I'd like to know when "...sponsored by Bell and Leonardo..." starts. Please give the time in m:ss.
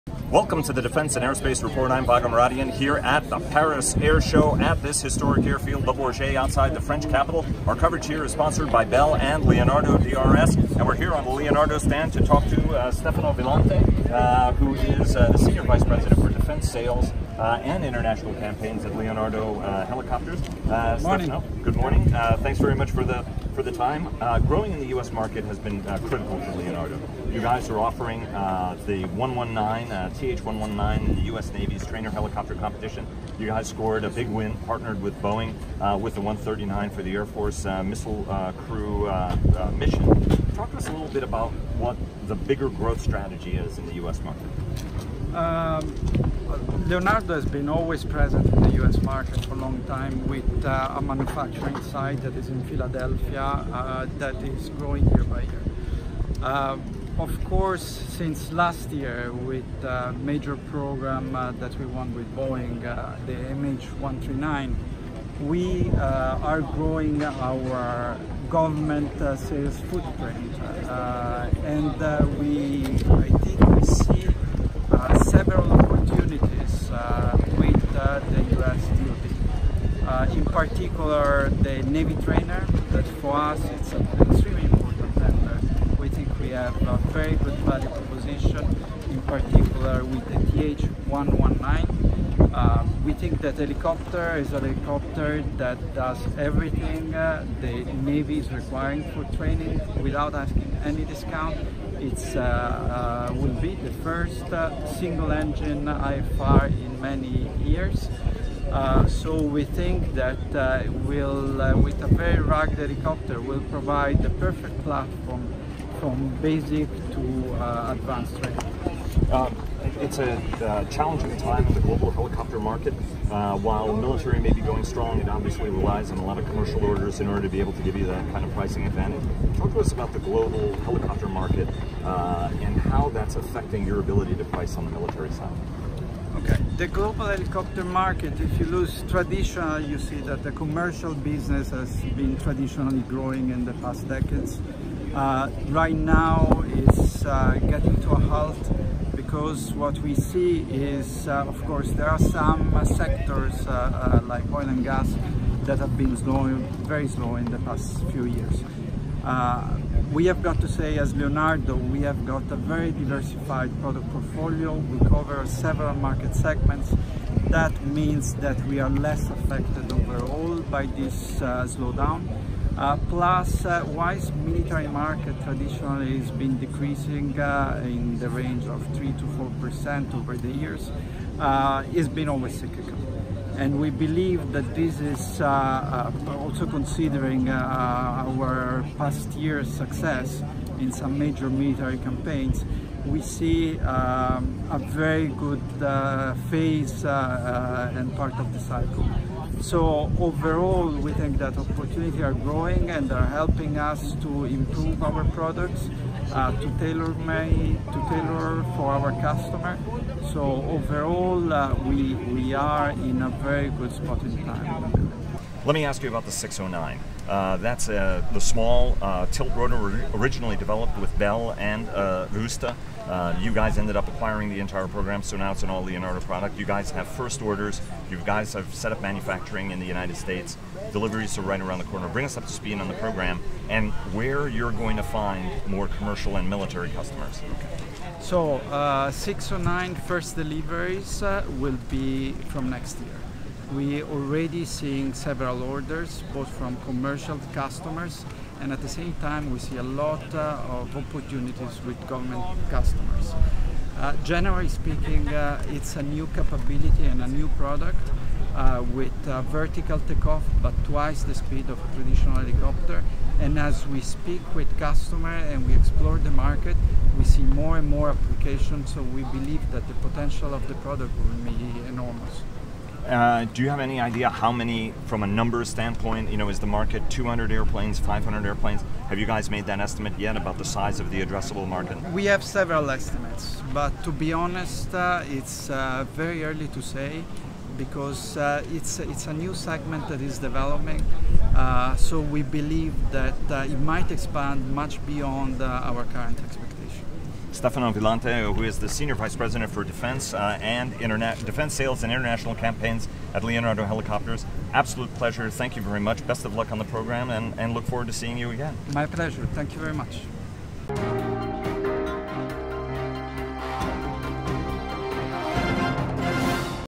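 0:08.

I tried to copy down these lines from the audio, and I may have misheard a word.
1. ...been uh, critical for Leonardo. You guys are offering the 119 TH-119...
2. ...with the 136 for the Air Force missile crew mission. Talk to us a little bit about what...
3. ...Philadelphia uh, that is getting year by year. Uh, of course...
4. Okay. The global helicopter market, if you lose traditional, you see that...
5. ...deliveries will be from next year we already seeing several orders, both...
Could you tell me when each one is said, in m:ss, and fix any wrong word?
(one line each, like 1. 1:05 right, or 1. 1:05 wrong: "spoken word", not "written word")
1. 0:25 right
2. 0:35 wrong: "139", not "136"
3. 0:52 wrong: "growing", not "getting"
4. 2:16 right
5. 4:00 right.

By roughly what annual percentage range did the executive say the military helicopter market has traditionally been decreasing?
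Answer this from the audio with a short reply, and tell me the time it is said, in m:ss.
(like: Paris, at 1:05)
3 to 4%, at 2:58.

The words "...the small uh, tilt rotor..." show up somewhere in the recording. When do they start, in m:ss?
3:38.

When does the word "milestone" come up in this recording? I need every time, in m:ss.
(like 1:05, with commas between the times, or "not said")
not said.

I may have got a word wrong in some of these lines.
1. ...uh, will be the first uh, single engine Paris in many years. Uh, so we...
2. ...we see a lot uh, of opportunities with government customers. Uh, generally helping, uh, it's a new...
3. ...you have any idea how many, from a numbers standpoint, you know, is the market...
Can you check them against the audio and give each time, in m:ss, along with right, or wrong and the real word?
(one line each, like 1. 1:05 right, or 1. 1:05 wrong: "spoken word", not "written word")
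1. 1:43 wrong: "IFR", not "Paris"
2. 4:09 wrong: "speaking", not "helping"
3. 4:33 right.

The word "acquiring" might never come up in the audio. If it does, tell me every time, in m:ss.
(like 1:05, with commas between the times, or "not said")
3:44.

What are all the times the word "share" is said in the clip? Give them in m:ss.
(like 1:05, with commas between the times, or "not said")
not said.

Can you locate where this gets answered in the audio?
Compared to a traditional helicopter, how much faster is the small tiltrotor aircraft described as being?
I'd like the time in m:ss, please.
4:20.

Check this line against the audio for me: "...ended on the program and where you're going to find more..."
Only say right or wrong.
wrong.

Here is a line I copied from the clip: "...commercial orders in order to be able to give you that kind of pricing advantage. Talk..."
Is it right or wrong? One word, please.
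right.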